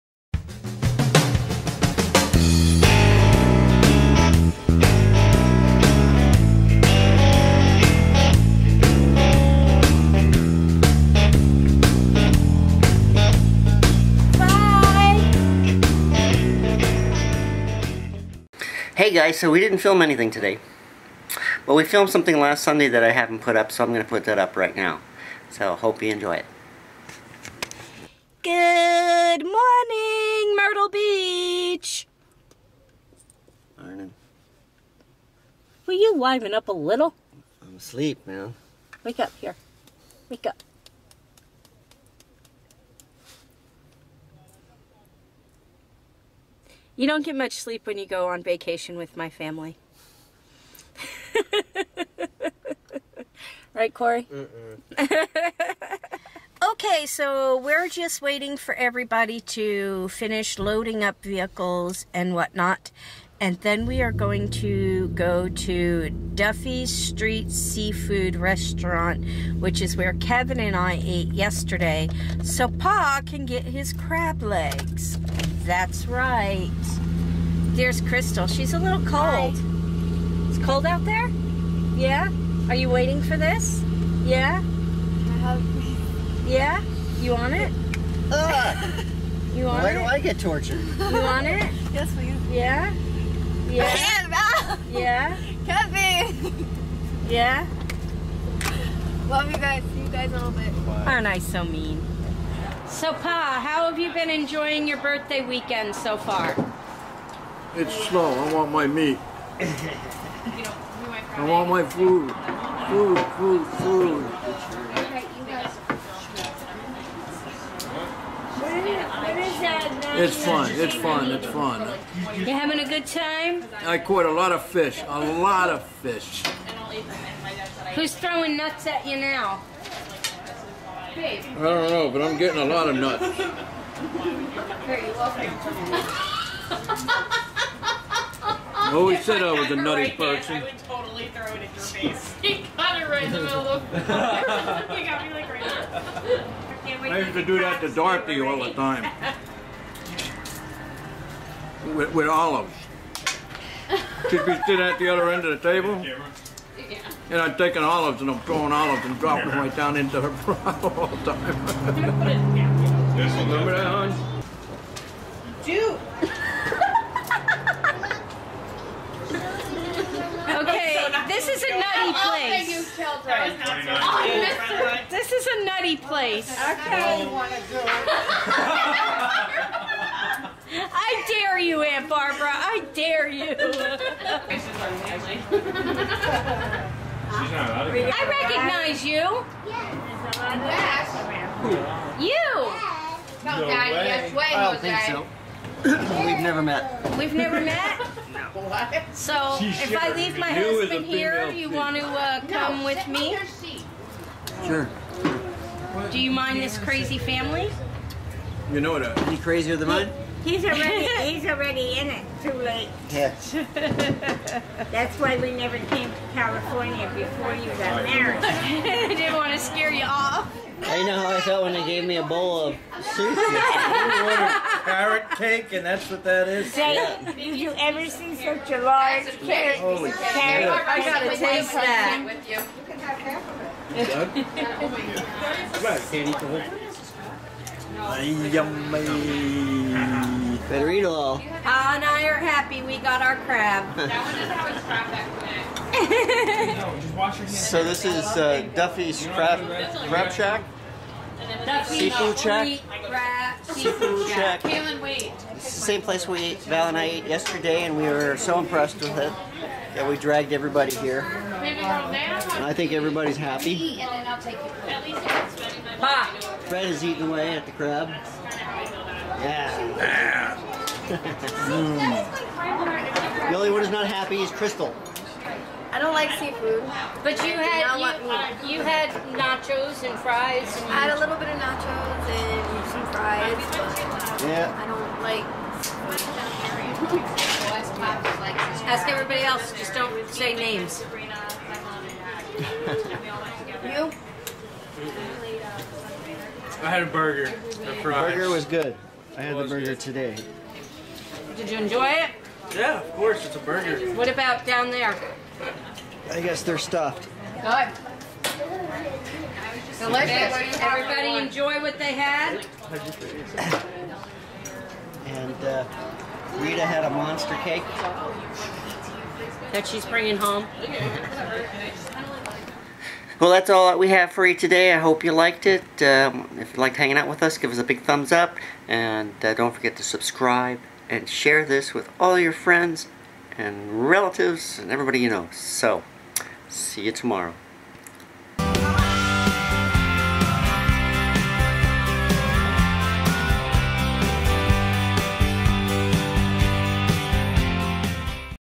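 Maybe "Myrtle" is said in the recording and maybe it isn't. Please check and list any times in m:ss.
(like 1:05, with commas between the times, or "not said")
0:30.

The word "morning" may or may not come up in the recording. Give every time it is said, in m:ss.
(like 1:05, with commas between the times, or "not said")
0:29, 0:33.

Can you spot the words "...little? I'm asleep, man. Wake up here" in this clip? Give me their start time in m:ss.
0:36.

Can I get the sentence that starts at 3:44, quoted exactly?
carrot cake, and that's what that is.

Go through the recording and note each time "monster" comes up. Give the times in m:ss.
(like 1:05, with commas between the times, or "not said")
5:17.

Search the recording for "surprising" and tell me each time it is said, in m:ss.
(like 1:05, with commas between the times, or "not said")
not said.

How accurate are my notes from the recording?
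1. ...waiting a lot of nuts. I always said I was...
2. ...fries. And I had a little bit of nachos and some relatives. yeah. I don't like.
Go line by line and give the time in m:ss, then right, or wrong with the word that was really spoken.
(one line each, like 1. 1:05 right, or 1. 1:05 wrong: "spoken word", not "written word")
1. 2:12 wrong: "getting", not "waiting"
2. 4:40 wrong: "fries", not "relatives".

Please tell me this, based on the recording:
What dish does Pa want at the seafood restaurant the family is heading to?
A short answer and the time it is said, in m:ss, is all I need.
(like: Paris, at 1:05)
Crab legs, at 1:13.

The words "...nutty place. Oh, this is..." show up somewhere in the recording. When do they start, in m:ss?
2:51.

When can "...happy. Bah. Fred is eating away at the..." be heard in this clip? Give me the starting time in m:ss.
4:23.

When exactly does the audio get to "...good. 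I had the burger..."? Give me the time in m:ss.
4:58.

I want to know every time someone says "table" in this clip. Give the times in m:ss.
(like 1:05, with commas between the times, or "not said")
2:35.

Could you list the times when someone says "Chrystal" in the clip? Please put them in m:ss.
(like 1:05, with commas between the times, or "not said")
1:18, 4:34.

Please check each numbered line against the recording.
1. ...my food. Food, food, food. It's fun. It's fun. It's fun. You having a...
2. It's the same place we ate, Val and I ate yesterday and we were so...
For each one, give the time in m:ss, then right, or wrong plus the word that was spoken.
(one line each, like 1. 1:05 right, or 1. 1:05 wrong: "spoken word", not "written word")
1. 1:51 right
2. 4:14 right.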